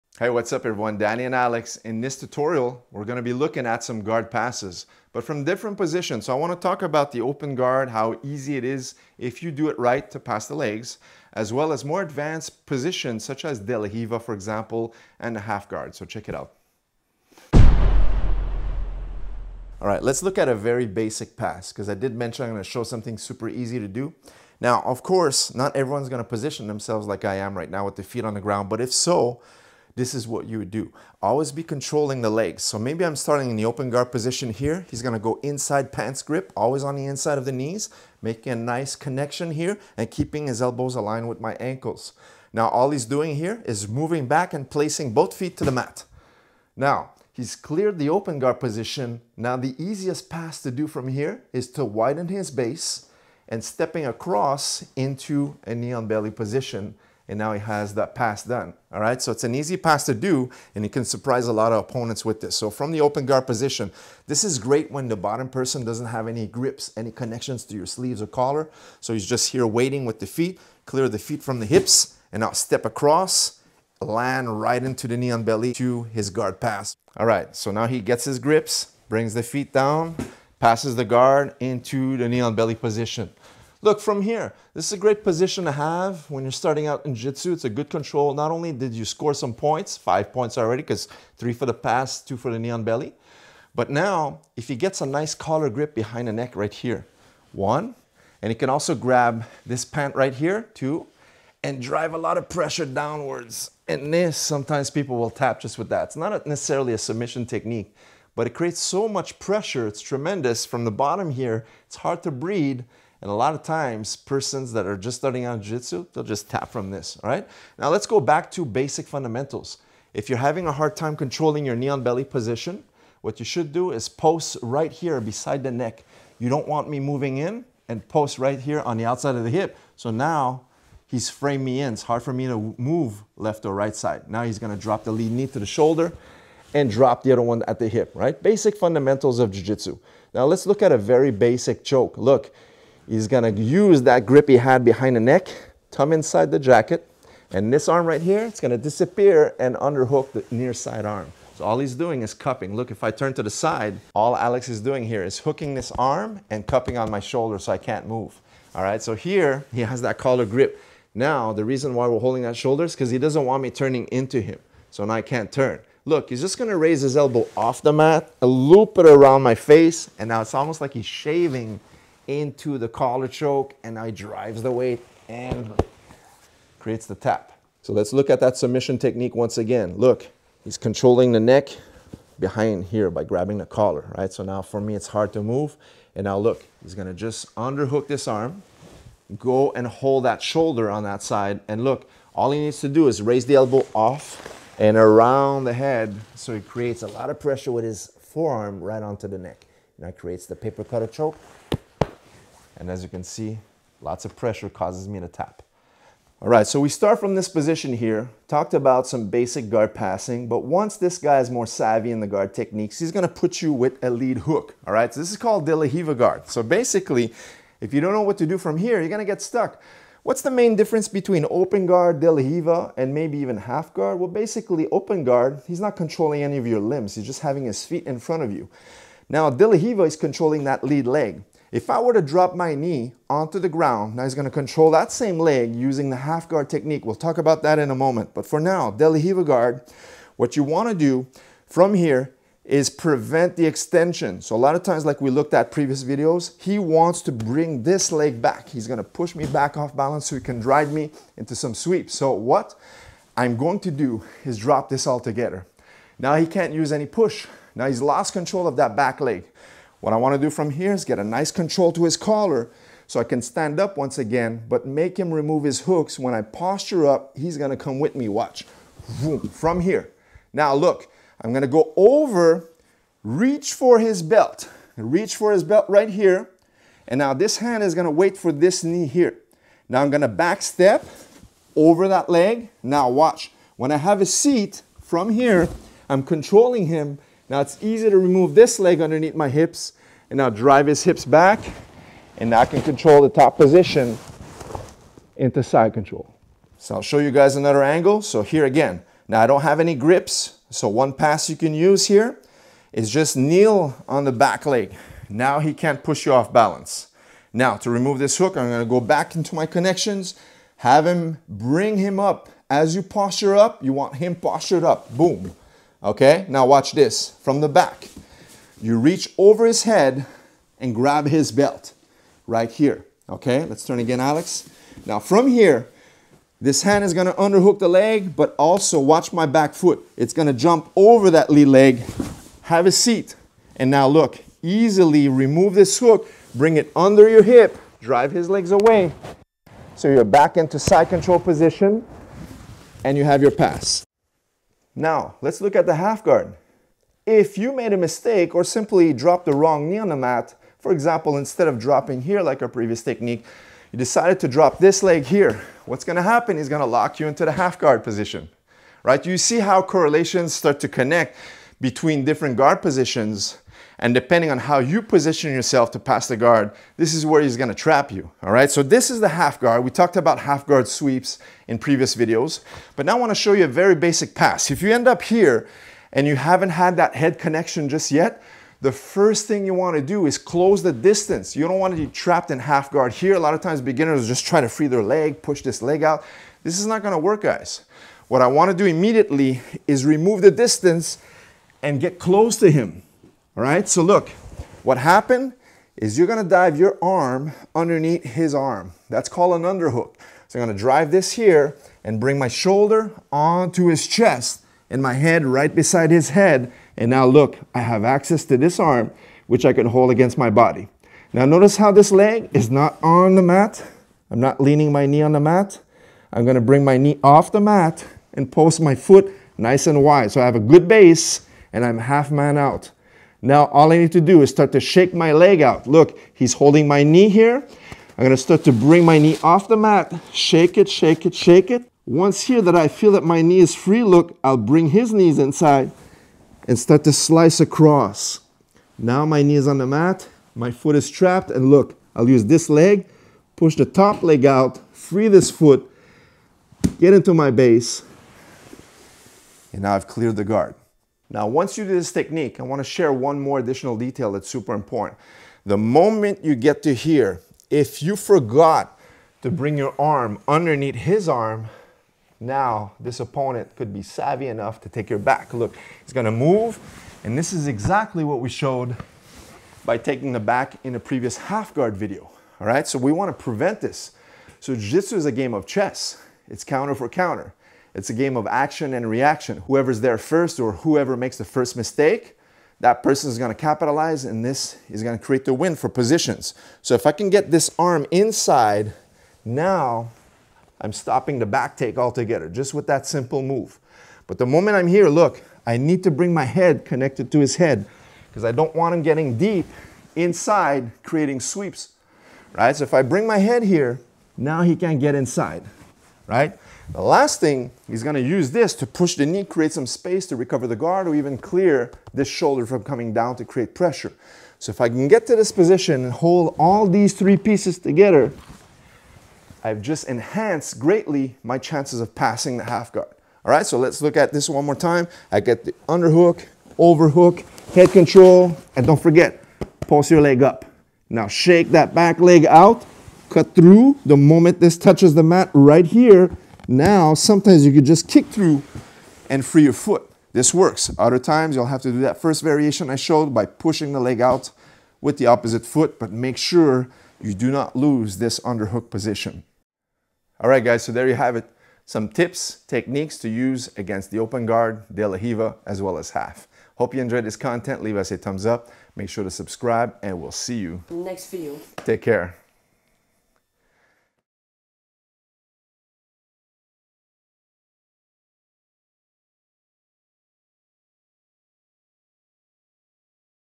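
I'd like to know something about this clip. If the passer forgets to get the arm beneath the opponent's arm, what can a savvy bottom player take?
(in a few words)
your back.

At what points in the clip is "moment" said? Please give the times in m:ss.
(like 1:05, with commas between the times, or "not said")
3:57, 7:35, 8:14, 8:54.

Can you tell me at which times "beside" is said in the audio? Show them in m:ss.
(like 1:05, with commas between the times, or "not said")
2:05, 6:45.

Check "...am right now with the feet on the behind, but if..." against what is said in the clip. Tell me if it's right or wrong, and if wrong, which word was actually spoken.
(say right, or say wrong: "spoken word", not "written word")
wrong: "ground", not "behind".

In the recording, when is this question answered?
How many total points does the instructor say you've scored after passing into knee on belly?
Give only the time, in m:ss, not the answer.
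1:29.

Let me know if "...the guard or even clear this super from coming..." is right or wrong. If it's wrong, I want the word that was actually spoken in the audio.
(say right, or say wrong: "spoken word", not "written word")
wrong: "shoulder", not "super".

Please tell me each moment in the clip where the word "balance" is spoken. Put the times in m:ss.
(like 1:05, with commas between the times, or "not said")
4:09, 5:06.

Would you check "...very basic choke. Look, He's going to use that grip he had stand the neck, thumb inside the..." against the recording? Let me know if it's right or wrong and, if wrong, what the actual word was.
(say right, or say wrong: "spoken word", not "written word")
wrong: "behind", not "stand".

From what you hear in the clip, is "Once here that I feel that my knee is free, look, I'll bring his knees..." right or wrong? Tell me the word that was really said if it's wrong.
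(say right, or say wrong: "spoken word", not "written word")
right.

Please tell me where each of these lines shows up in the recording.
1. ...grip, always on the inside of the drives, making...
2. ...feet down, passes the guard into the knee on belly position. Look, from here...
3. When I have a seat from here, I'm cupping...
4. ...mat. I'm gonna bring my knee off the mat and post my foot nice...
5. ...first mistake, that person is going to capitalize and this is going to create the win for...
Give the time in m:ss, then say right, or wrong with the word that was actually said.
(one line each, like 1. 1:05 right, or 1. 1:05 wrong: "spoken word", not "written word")
1. 0:36 wrong: "knees", not "drives"
2. 1:19 right
3. 4:43 wrong: "controlling", not "cupping"
4. 6:55 right
5. 8:01 right.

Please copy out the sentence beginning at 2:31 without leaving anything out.
So all he's doing is cupping.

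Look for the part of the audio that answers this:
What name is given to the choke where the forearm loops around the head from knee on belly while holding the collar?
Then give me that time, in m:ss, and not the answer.
3:20.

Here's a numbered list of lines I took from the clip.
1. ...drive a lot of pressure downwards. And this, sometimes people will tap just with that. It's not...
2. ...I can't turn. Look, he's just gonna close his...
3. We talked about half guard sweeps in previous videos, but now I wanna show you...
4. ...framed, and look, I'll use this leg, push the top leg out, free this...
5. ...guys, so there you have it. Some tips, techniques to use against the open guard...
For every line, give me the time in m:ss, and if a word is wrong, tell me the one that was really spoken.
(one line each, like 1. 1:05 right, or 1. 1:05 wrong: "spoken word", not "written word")
1. 1:41 right
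2. 2:45 wrong: "raise", not "close"
3. 6:09 right
4. 7:21 wrong: "trapped", not "framed"
5. 9:10 right.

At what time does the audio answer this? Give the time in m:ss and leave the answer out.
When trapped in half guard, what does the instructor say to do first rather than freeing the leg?
6:20.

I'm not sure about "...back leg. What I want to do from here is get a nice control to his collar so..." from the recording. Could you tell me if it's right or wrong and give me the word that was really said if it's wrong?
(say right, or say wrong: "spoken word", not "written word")
right.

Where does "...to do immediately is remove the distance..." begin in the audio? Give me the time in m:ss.
6:28.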